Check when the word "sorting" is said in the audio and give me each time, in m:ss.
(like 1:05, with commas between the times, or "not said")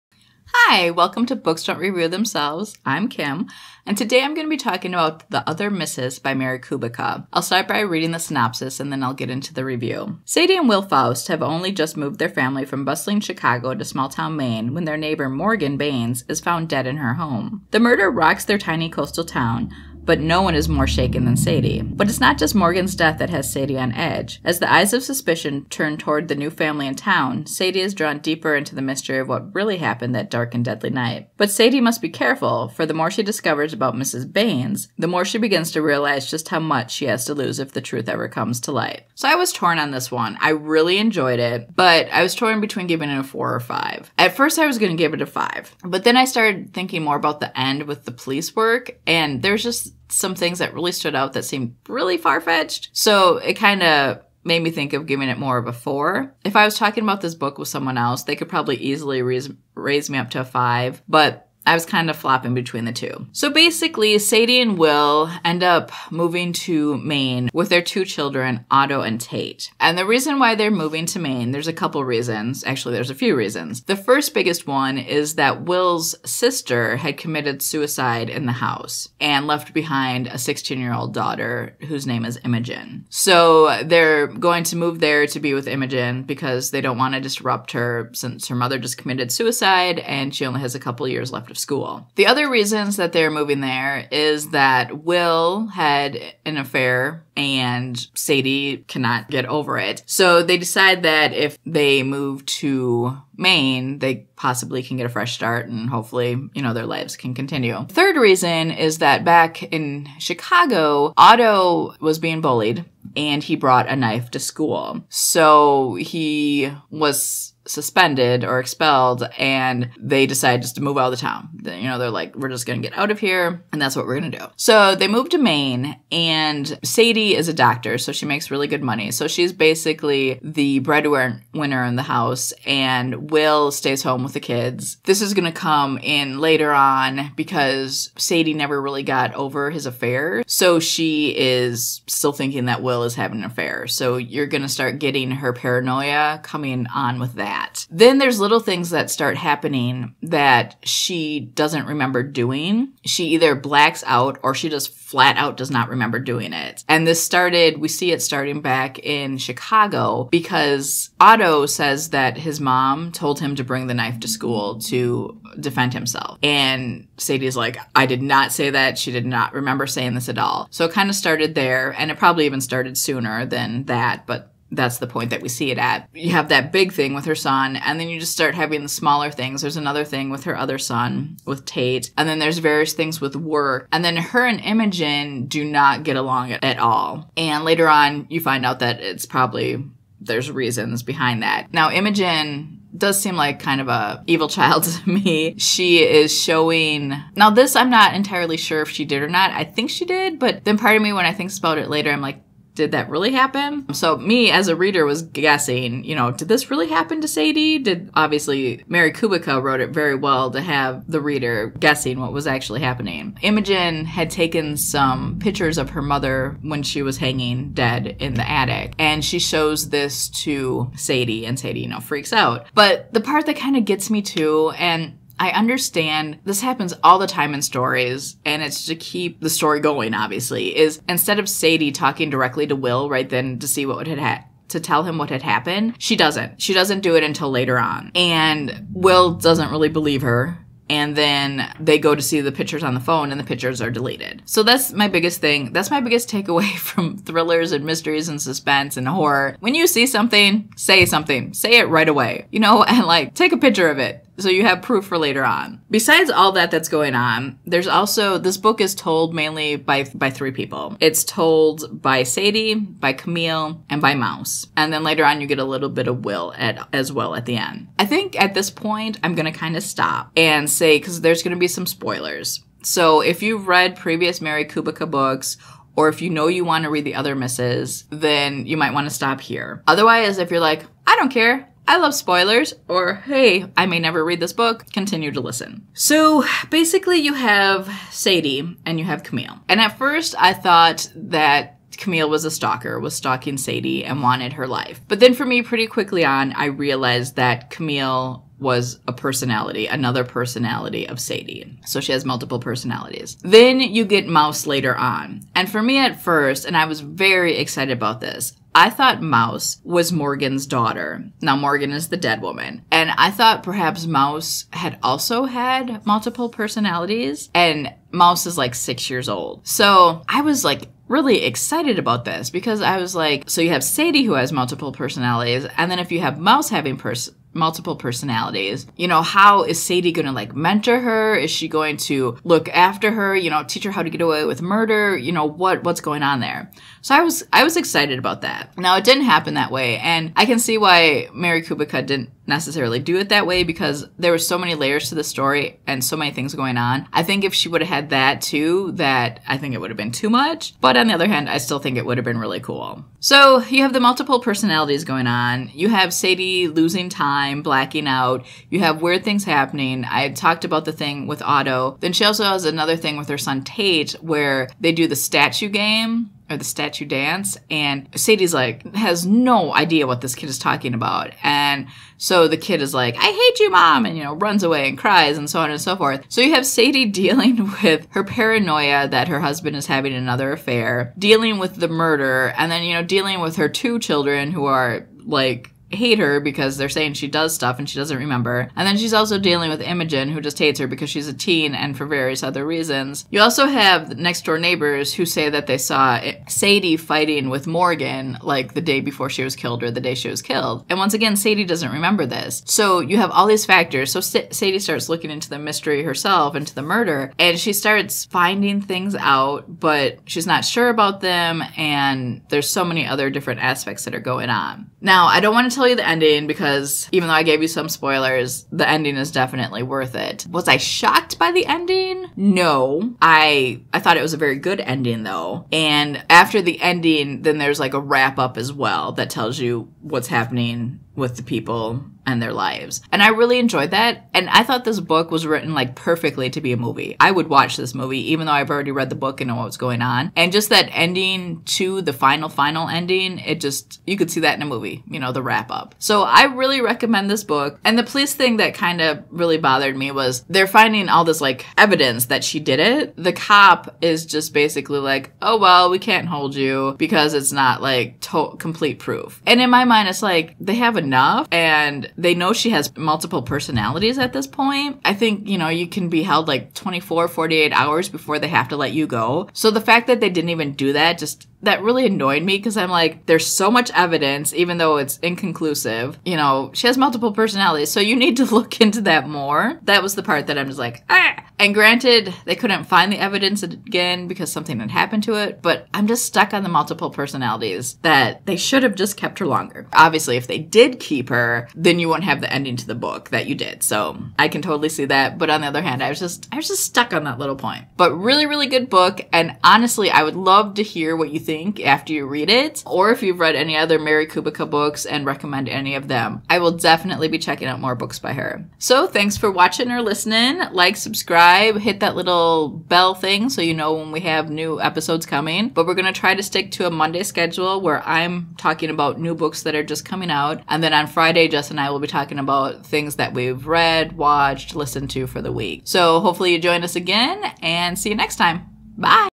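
not said.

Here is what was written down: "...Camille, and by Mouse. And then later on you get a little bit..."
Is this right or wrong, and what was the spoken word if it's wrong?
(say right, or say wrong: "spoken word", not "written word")
right.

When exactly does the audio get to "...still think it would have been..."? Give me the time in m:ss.
5:51.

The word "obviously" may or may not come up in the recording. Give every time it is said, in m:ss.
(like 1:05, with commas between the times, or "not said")
3:28, 3:50, 8:09.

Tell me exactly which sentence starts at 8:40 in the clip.
And then on Friday, Jess and I will be talking about things that we've read, watched, listened to for the week.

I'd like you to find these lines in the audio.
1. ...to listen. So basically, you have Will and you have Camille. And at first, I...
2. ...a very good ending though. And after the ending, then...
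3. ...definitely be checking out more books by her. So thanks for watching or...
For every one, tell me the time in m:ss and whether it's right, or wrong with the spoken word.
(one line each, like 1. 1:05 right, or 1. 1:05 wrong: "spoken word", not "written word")
1. 4:45 wrong: "Sadie", not "Will"
2. 7:04 right
3. 8:26 right.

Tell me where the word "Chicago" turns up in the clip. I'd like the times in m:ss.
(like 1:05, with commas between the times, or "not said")
0:13, 1:50, 2:39.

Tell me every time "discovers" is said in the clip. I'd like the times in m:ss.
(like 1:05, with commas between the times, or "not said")
0:33.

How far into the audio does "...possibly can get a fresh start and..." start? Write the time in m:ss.
1:44.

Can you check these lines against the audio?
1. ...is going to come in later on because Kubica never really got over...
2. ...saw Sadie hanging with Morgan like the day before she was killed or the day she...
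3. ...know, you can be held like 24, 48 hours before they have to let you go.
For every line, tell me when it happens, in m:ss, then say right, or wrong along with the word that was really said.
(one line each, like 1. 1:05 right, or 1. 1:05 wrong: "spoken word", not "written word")
1. 2:15 wrong: "Sadie", not "Kubica"
2. 6:35 wrong: "fighting", not "hanging"
3. 7:45 right.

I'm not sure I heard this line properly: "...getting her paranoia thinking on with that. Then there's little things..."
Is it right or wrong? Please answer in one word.
wrong.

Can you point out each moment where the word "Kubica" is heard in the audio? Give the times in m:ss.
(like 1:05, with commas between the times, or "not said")
0:06, 3:29, 4:34, 5:41, 8:24.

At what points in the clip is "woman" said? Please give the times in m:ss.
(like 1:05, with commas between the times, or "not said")
5:12.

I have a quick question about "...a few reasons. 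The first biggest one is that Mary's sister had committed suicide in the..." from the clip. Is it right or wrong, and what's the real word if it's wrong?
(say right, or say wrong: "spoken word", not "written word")
wrong: "Will", not "Mary".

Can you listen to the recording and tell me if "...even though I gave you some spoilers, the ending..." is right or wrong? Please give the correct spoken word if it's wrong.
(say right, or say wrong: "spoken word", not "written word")
right.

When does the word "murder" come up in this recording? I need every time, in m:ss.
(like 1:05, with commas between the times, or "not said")
0:17, 5:34, 6:21, 6:46.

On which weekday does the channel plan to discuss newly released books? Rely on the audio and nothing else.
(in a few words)
Monday.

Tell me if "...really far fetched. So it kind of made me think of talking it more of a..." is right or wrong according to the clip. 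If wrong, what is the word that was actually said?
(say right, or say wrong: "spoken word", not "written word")
wrong: "giving", not "talking".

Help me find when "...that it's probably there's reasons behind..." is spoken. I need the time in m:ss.
3:08.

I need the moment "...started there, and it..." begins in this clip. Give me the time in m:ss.
2:51.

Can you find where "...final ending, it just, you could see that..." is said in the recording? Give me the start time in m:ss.
7:22.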